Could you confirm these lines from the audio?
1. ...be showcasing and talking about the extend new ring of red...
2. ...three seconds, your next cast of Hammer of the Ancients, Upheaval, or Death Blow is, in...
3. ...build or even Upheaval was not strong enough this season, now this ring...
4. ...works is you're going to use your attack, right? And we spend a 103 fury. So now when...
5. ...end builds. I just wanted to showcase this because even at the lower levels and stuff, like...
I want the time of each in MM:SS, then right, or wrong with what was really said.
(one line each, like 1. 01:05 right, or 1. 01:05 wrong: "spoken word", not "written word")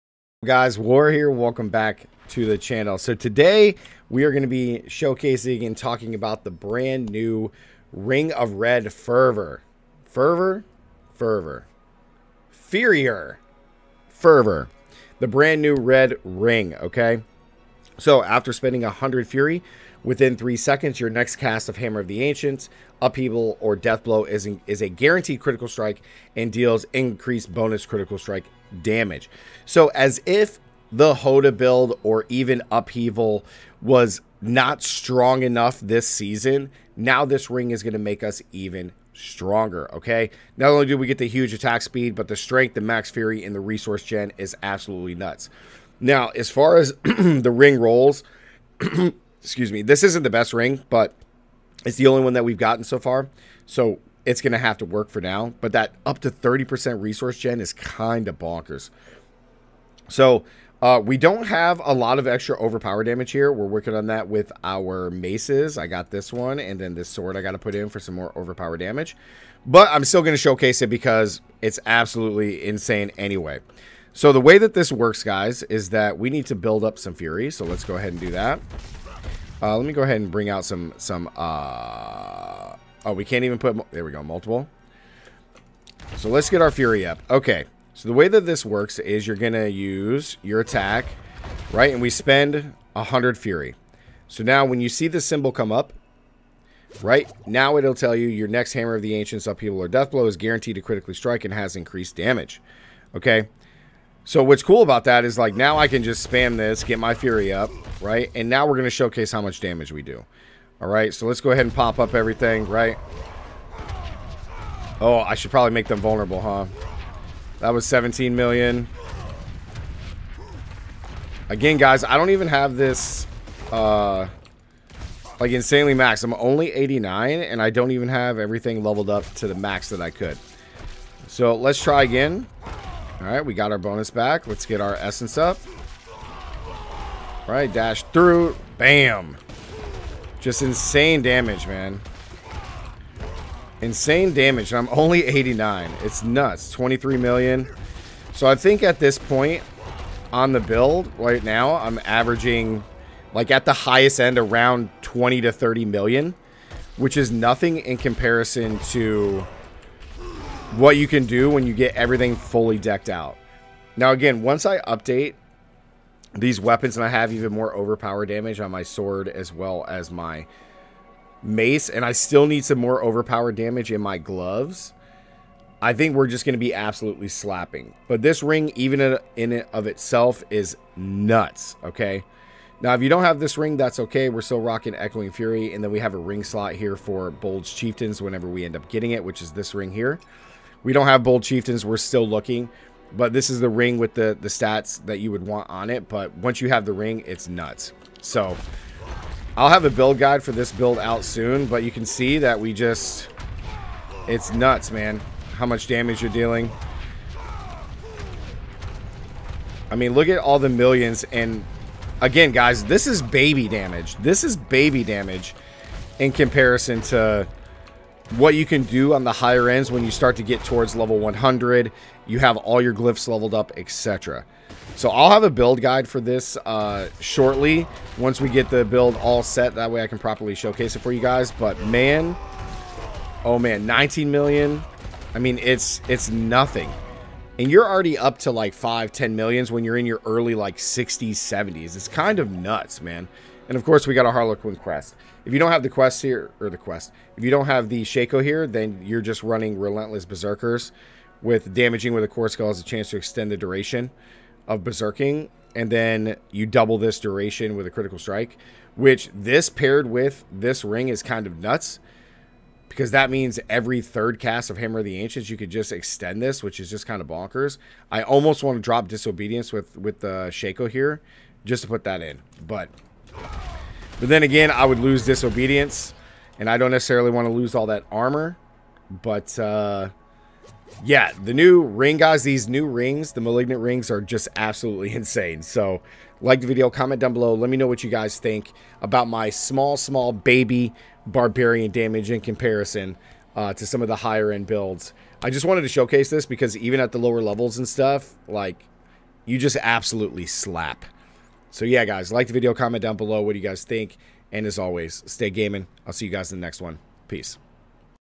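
1. 00:04 wrong: "brand", not "extend"
2. 00:20 right
3. 00:31 right
4. 01:28 wrong: "100", not "103"
5. 04:54 right.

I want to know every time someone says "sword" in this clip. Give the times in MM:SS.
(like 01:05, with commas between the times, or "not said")
01:07, 02:48.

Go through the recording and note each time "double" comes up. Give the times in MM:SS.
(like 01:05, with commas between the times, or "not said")
04:16.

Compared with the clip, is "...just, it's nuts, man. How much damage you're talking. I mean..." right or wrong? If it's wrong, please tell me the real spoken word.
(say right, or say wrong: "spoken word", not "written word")
wrong: "dealing", not "talking".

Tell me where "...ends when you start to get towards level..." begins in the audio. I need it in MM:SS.
03:39.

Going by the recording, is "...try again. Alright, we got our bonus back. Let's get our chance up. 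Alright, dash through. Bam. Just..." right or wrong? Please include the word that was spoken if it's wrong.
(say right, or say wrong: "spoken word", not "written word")
wrong: "essence", not "chance".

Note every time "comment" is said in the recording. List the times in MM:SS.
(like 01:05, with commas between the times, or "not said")
04:46, 05:02.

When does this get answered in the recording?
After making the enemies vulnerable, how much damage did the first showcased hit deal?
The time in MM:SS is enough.
01:57.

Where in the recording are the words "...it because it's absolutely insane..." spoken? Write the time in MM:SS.
01:10.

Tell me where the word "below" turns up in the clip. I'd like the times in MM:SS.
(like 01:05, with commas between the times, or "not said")
04:47, 05:03.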